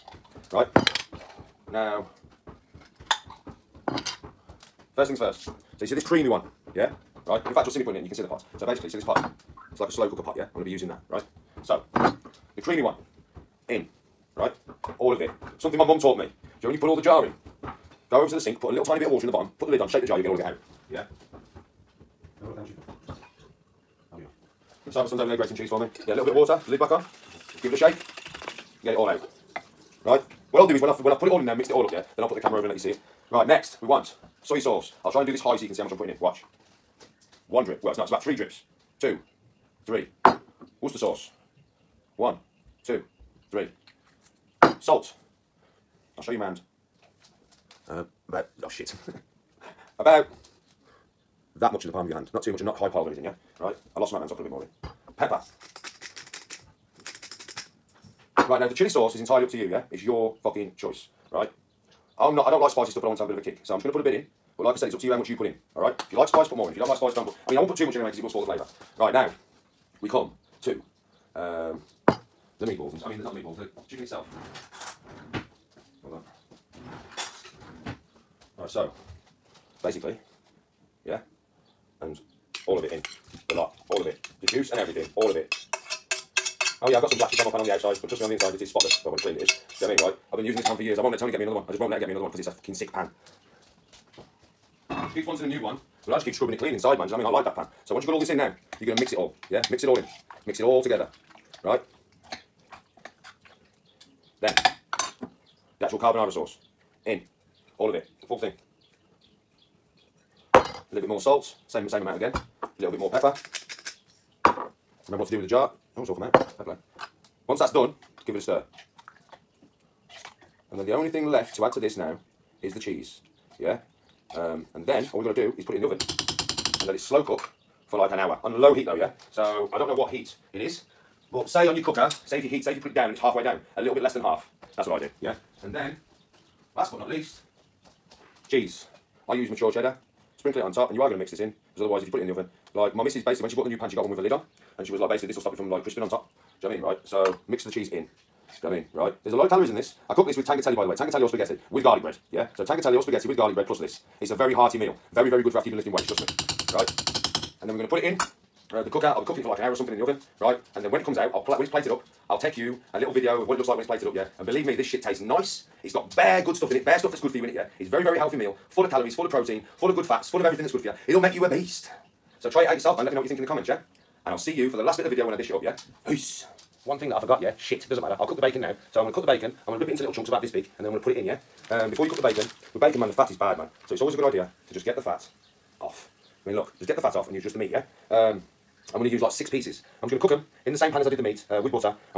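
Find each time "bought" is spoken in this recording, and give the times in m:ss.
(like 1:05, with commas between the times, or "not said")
2:23.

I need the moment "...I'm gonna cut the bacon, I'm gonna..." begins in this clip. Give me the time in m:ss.
2:59.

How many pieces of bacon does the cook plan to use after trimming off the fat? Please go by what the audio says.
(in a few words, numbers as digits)
6.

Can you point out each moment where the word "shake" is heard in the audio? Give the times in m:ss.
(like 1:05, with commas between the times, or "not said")
0:19, 0:27.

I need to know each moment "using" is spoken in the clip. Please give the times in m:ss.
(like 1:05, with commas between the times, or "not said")
0:10, 1:30.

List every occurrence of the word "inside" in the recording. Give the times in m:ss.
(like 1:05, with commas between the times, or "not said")
1:28, 1:36.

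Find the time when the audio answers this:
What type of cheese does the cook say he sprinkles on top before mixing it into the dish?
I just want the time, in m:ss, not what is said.
2:19.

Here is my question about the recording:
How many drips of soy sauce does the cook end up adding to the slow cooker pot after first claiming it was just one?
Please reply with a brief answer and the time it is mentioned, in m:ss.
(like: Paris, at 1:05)
3, at 0:38.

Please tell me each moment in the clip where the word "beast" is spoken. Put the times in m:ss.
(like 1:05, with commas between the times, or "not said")
2:51.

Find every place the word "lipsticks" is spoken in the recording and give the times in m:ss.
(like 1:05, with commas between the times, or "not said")
not said.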